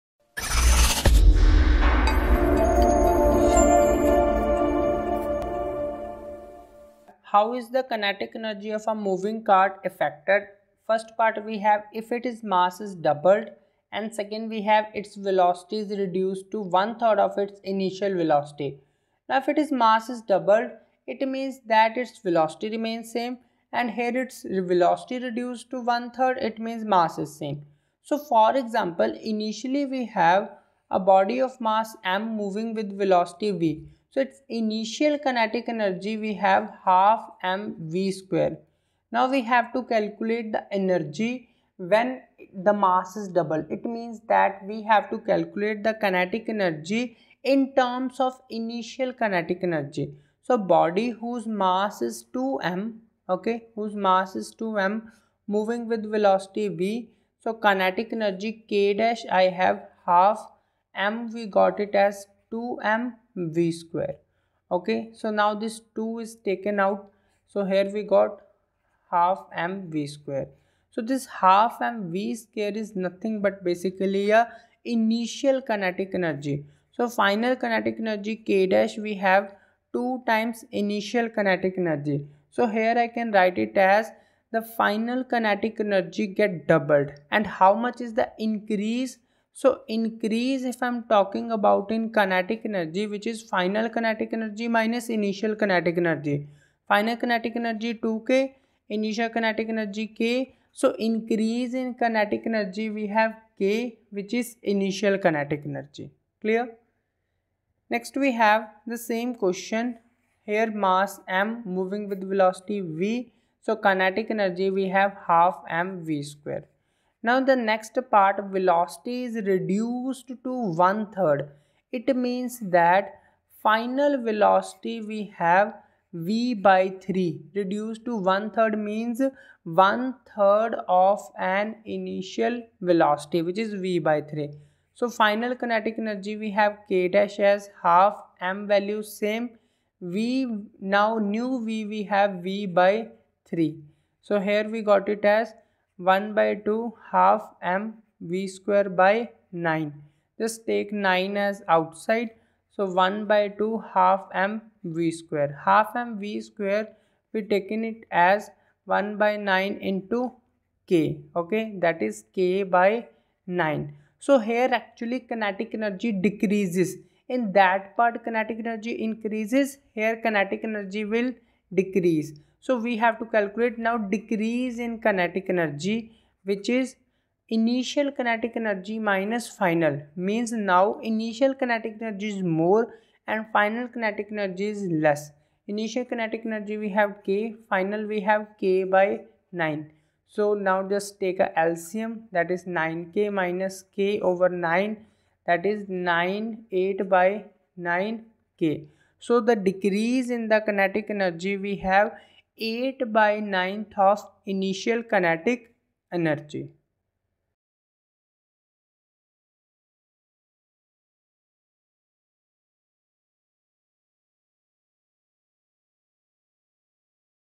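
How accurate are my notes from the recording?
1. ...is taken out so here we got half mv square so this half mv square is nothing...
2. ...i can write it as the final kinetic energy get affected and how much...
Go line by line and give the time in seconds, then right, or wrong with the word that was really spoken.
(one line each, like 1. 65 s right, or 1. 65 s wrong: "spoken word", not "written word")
1. 66 s right
2. 83 s wrong: "doubled", not "affected".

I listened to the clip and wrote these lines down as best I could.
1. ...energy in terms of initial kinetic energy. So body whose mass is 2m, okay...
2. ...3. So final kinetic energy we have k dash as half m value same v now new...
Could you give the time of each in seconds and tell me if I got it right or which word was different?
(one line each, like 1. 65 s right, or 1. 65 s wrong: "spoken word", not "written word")
1. 46 s right
2. 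134 s right.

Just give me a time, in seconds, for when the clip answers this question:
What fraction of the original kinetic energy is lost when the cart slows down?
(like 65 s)
202 s.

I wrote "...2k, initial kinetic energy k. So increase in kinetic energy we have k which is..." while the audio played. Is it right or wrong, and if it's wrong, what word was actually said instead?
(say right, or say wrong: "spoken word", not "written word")
right.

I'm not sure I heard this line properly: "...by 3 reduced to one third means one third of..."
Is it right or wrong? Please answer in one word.
right.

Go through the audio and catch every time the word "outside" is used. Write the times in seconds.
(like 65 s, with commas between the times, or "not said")
151 s.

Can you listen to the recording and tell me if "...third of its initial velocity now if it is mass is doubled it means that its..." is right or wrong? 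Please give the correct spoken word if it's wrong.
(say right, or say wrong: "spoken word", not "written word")
right.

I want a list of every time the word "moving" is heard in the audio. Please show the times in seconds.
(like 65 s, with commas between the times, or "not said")
9 s, 32 s, 55 s, 111 s.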